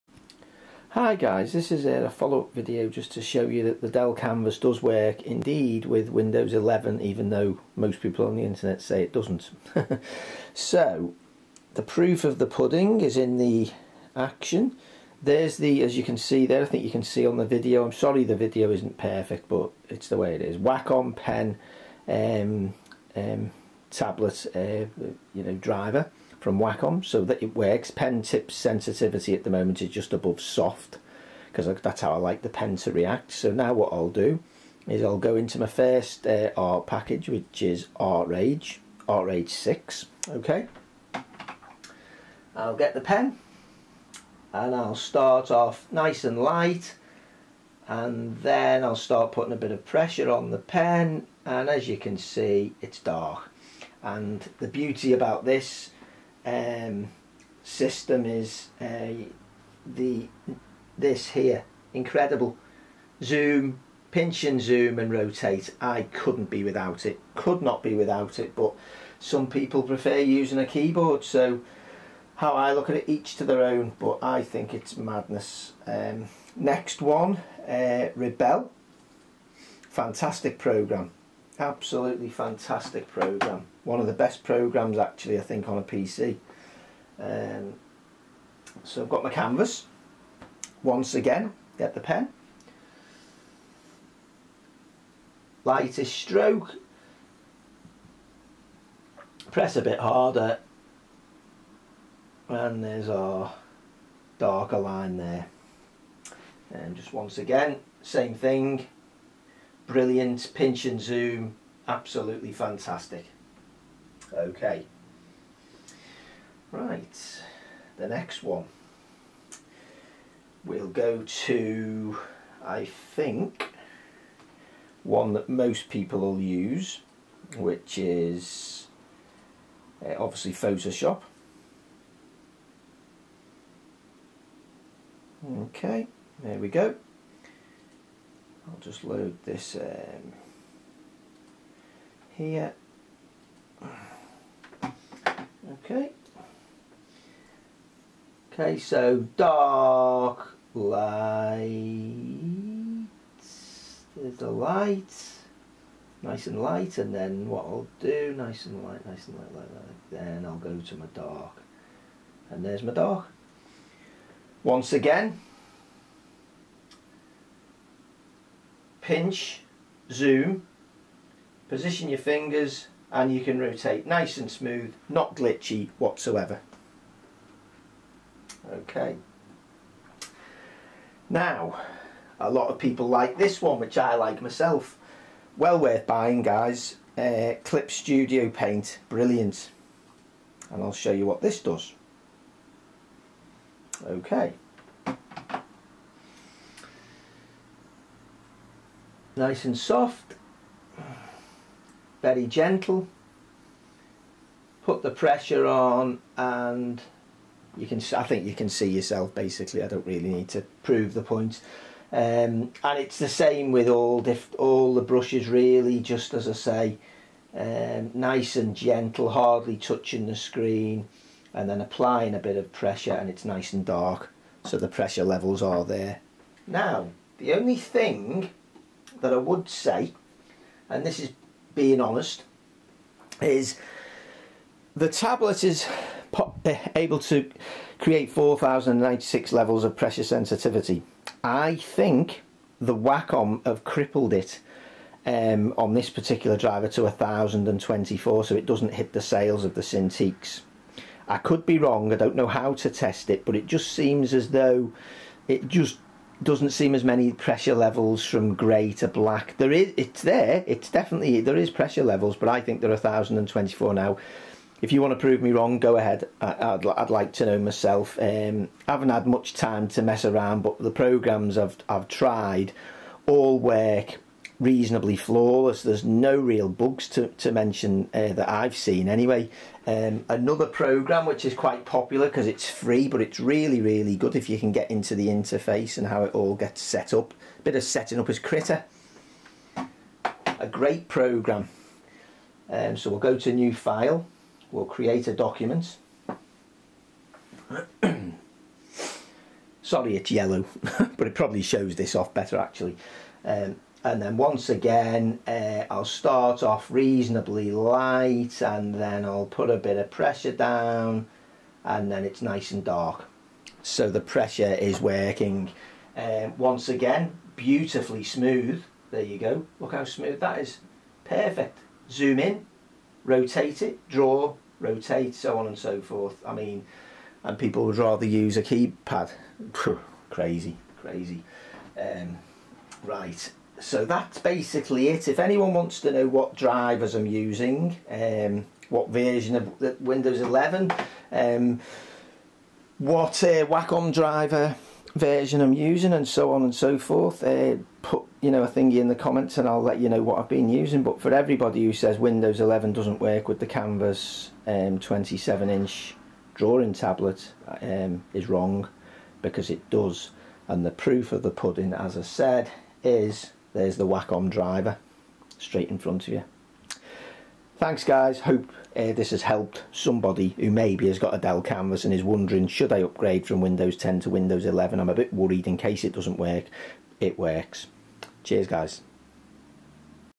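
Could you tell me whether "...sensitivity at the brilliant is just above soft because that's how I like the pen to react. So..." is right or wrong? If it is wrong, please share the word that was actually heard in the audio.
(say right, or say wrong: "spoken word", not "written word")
wrong: "moment", not "brilliant".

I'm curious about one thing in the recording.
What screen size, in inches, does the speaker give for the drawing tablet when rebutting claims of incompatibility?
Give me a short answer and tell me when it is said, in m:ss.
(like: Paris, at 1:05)
27, at 5:54.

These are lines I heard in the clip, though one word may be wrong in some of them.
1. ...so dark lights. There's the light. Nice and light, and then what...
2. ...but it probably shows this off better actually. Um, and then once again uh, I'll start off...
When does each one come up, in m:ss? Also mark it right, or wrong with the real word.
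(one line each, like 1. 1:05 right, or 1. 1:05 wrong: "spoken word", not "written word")
1. 2:28 right
2. 5:01 right.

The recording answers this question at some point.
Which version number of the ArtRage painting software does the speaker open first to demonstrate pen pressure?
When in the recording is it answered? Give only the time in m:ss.
0:39.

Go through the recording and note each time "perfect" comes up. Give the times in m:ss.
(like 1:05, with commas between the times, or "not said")
0:18, 5:21.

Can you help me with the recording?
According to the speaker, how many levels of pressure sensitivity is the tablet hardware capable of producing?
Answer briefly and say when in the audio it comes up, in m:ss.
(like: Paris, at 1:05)
4096, at 3:58.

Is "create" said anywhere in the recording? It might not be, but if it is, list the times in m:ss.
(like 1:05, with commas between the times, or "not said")
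3:57, 4:54.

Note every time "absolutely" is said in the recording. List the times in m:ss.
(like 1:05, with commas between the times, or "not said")
1:21, 1:51.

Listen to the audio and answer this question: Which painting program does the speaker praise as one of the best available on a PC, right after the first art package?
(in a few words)
Rebelle.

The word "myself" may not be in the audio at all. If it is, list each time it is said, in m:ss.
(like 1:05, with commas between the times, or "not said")
3:04, 4:27.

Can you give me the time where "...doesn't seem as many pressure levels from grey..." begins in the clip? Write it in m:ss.
4:16.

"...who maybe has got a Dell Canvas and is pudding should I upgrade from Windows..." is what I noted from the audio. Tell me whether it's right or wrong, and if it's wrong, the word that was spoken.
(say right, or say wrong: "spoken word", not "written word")
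wrong: "wondering", not "pudding".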